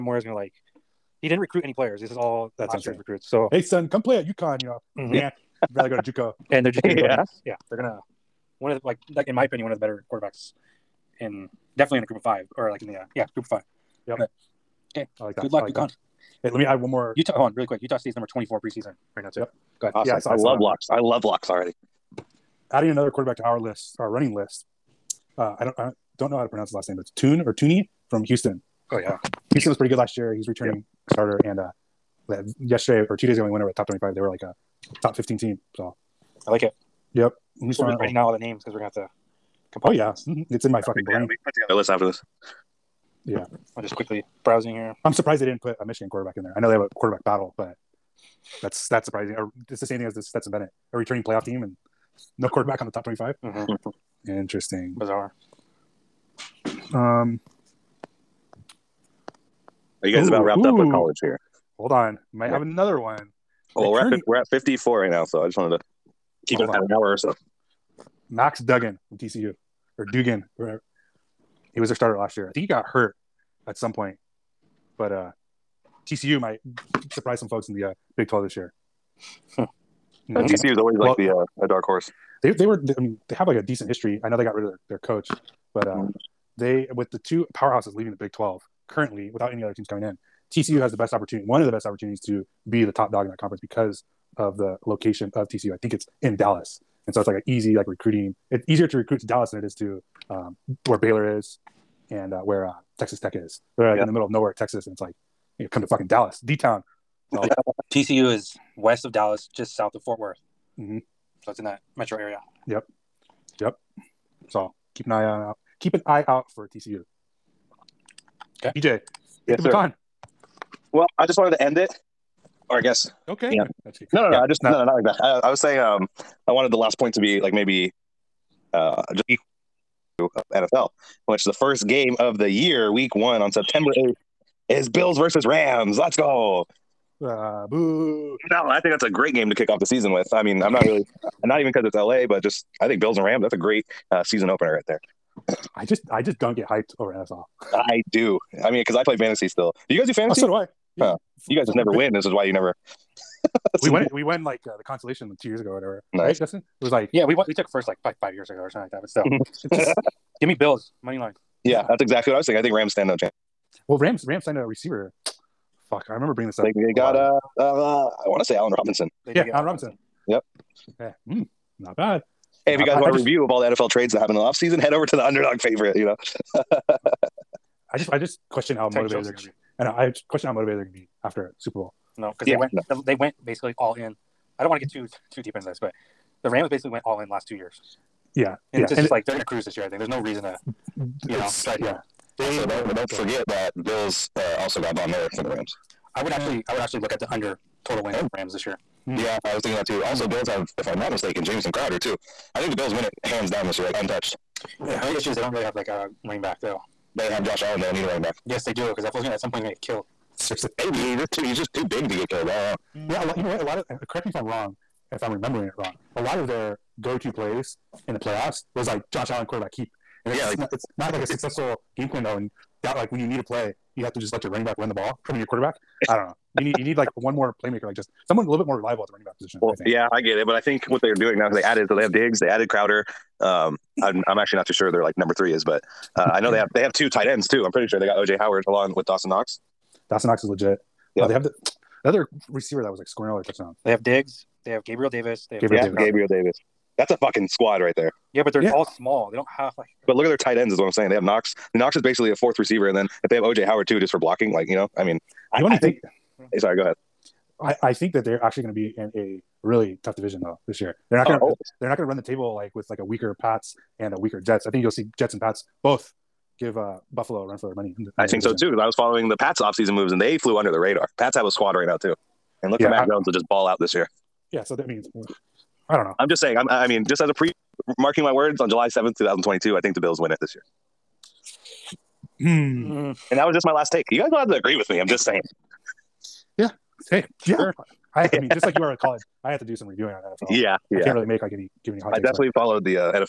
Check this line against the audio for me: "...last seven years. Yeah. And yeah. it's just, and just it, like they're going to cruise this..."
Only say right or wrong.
wrong.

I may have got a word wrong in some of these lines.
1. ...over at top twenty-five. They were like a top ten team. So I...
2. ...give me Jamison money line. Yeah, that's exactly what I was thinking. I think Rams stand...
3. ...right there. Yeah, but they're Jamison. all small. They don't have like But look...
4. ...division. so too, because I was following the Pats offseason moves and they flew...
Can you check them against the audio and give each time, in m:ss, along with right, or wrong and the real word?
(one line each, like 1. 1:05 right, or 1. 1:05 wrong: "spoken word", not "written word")
1. 0:33 wrong: "fifteen", not "ten"
2. 2:40 wrong: "Bills", not "Jamison"
3. 4:07 wrong: "Yeah", not "Jamison"
4. 4:28 right.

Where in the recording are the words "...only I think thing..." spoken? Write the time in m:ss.
4:15.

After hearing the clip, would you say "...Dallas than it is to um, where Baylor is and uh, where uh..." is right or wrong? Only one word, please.
right.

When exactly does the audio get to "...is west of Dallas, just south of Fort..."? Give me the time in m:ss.
1:48.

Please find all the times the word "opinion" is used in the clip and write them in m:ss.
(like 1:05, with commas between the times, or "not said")
0:09.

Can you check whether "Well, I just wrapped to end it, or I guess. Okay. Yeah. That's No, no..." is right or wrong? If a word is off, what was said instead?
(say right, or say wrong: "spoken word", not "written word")
wrong: "wanted", not "wrapped".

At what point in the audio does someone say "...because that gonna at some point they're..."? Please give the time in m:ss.
3:28.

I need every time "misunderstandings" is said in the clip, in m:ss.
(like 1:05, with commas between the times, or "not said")
not said.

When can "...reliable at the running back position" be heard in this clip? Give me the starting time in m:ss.
3:48.